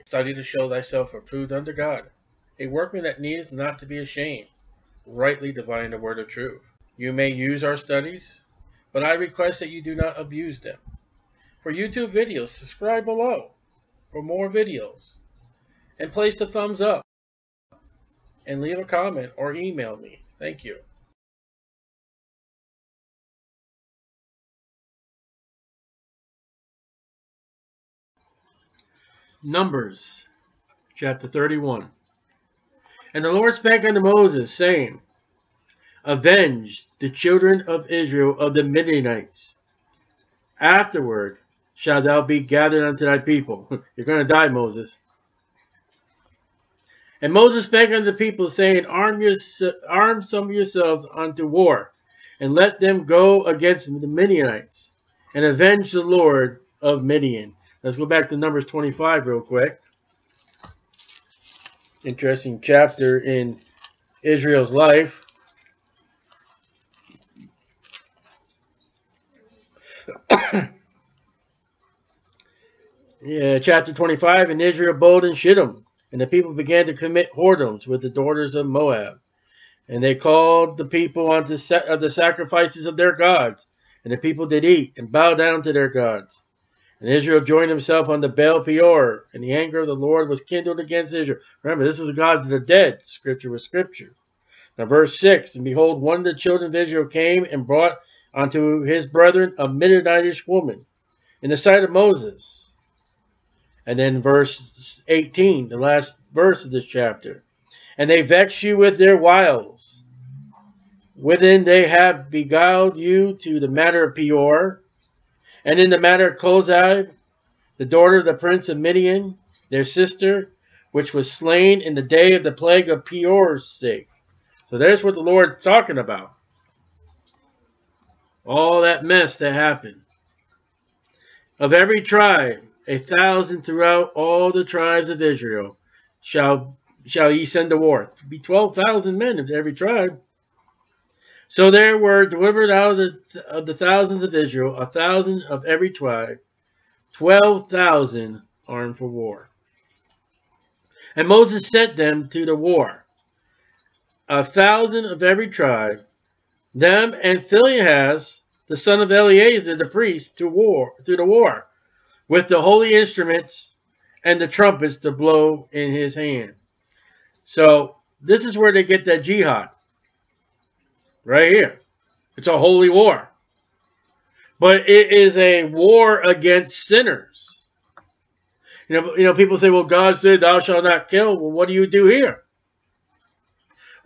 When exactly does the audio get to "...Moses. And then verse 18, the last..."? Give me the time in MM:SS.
01:41.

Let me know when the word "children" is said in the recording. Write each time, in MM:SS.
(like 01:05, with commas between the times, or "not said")
00:37, 01:36.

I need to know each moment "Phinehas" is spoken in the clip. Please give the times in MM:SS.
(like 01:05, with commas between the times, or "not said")
02:37.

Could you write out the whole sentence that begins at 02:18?
It'd be 12,000 men of every tribe.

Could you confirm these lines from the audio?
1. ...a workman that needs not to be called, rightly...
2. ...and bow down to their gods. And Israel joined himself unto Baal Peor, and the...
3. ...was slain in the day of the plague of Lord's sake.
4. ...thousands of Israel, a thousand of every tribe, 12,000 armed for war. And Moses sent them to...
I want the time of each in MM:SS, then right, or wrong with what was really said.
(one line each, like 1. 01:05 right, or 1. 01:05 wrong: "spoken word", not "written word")
1. 00:02 wrong: "ashamed", not "called"
2. 01:24 right
3. 02:01 wrong: "Peor", not "Lord"
4. 02:23 right.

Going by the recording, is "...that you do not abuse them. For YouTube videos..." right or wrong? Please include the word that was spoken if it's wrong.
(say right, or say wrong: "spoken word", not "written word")
right.